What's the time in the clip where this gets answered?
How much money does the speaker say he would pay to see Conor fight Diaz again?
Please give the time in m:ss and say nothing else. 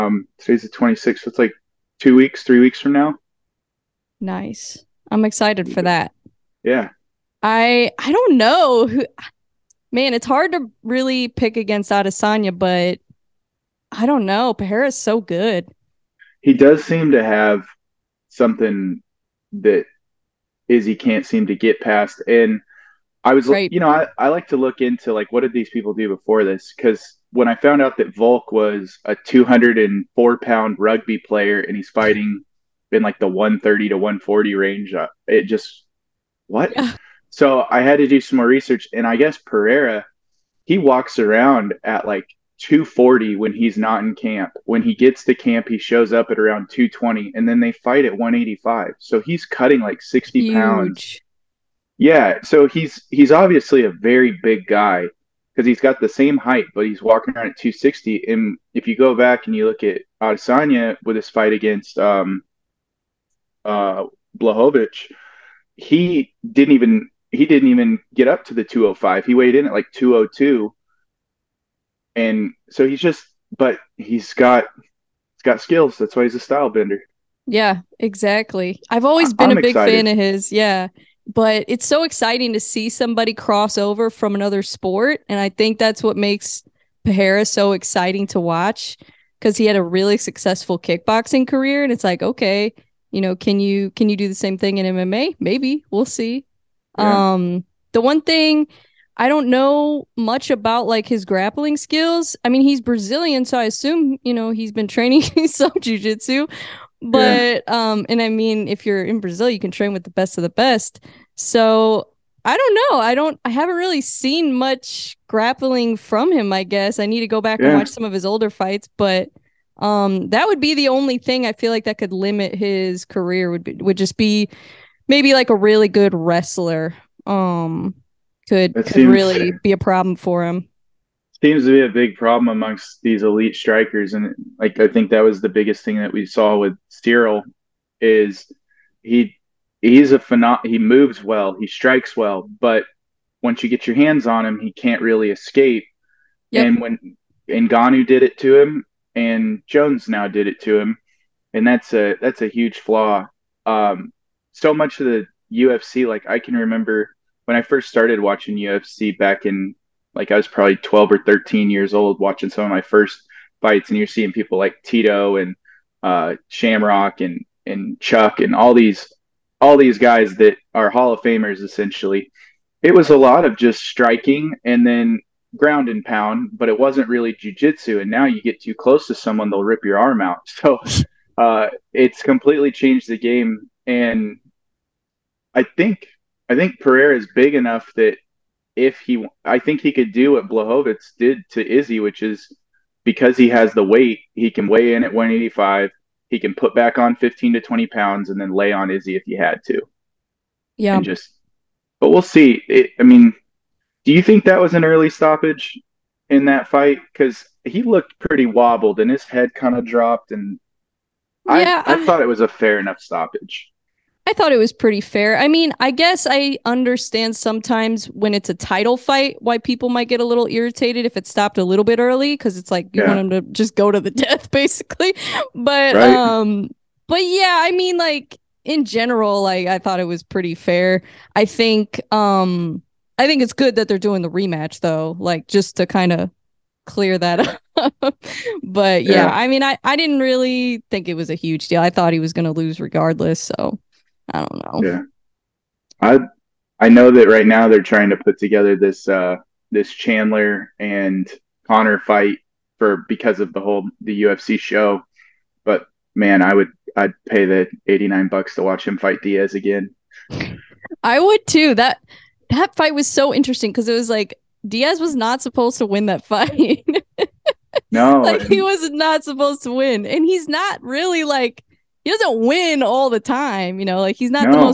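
4:17.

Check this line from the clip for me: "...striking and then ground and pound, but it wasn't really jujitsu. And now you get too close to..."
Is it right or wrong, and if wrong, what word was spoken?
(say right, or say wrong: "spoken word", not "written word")
right.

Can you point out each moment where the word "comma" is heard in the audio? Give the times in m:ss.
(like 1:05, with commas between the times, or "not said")
not said.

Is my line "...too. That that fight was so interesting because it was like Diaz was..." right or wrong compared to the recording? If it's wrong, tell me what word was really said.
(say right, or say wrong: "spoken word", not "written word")
right.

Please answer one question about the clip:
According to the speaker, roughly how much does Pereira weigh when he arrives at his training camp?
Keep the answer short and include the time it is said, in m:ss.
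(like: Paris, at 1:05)
220, at 0:46.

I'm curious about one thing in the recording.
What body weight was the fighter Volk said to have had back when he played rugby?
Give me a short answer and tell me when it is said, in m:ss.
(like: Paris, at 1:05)
204 pounds, at 0:29.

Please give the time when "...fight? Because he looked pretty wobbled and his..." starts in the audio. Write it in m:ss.
3:26.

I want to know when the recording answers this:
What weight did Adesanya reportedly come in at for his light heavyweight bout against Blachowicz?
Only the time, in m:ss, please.
1:09.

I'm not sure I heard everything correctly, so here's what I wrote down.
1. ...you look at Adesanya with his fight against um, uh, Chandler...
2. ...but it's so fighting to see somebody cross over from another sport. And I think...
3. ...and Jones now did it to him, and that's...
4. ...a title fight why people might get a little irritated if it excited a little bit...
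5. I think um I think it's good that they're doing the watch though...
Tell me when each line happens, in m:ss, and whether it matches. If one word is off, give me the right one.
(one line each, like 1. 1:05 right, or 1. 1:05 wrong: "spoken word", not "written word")
1. 0:59 wrong: "Blachowicz", not "Chandler"
2. 1:21 wrong: "exciting", not "fighting"
3. 2:29 right
4. 3:38 wrong: "stopped", not "excited"
5. 3:51 wrong: "rematch", not "watch".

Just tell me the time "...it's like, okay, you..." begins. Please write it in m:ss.
1:31.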